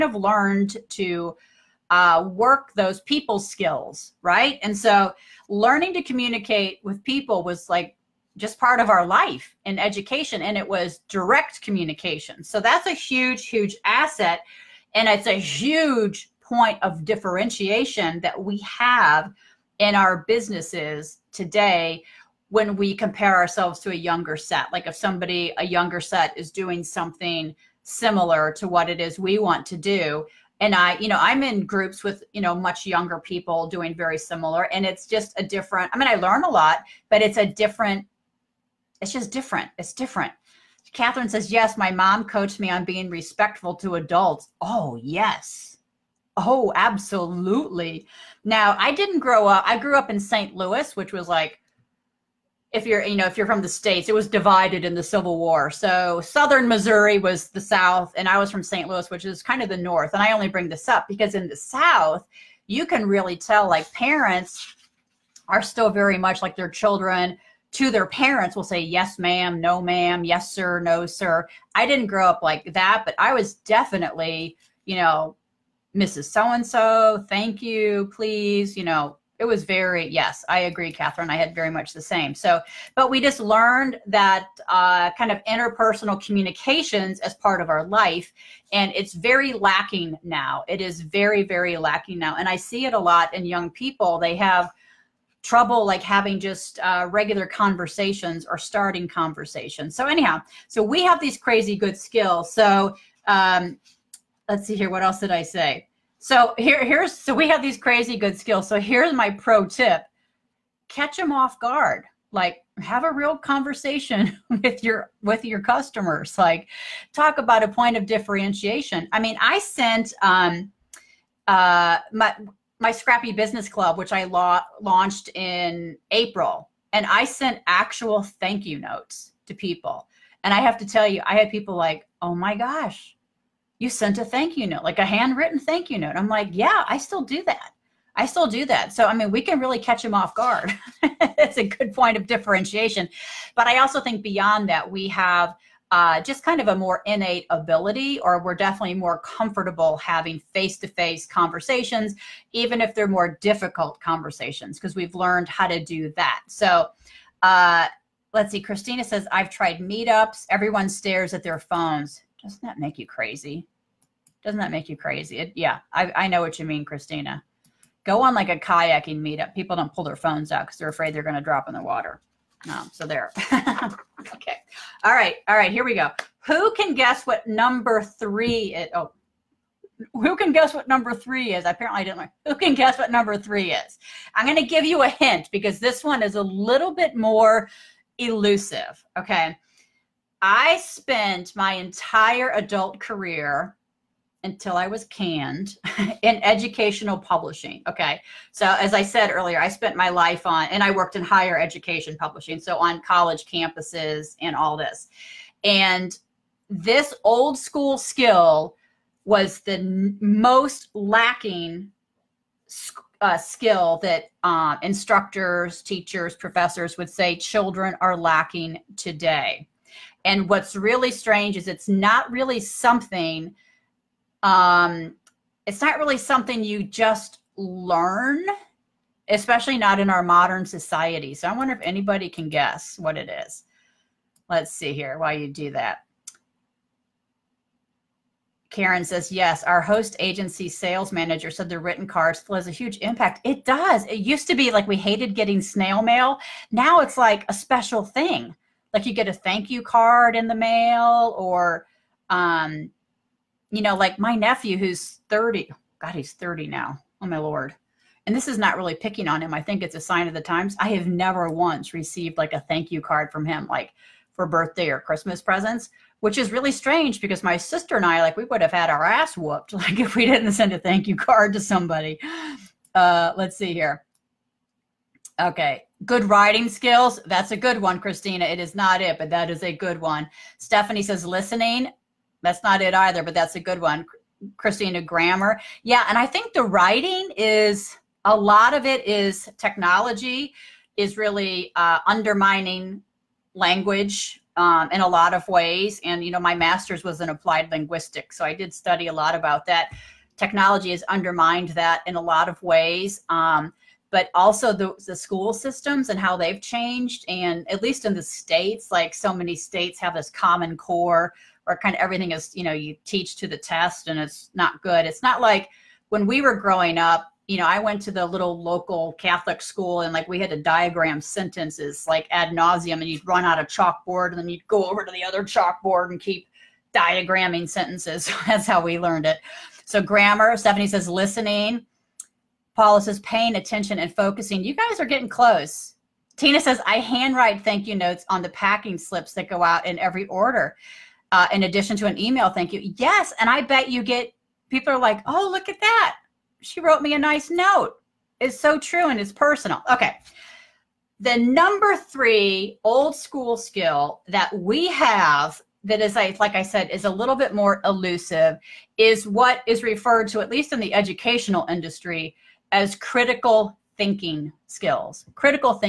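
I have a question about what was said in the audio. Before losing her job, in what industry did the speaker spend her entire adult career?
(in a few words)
Educational publishing.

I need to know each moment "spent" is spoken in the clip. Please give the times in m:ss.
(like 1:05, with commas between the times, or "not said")
3:10, 3:19.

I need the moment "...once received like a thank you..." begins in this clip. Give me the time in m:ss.
4:21.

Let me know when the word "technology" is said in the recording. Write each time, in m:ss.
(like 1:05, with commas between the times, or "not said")
4:49, 5:00.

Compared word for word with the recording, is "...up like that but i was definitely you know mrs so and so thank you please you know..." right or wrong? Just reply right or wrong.
right.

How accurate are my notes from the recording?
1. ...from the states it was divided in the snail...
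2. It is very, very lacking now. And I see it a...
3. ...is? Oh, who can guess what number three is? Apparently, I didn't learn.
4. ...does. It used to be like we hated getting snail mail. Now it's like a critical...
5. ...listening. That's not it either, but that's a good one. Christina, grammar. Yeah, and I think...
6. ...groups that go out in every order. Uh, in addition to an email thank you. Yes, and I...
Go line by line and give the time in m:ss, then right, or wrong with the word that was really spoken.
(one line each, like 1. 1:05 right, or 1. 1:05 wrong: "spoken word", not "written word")
1. 0:53 wrong: "civil", not "snail"
2. 1:30 right
3. 2:58 right
4. 4:03 wrong: "special", not "critical"
5. 4:41 right
6. 5:38 wrong: "slips", not "groups".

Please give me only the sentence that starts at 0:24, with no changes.
Like if somebody, a younger set is doing something similar to what it is we want to do.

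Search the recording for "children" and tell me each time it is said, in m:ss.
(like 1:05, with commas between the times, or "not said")
1:06, 3:37.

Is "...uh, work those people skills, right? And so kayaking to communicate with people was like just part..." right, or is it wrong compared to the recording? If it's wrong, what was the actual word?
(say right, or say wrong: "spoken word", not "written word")
wrong: "learning", not "kayaking".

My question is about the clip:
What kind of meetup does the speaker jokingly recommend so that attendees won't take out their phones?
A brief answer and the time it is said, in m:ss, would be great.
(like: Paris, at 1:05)
Kayaking meetup, at 2:48.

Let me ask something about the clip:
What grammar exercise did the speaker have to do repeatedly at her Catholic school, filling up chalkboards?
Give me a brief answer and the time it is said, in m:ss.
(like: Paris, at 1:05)
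Diagram sentences, at 5:20.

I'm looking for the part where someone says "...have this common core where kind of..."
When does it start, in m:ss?
5:10.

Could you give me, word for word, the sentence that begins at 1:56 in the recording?
Like talk about a point of differentiation.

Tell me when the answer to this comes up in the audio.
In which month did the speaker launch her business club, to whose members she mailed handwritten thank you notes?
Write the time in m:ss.
2:06.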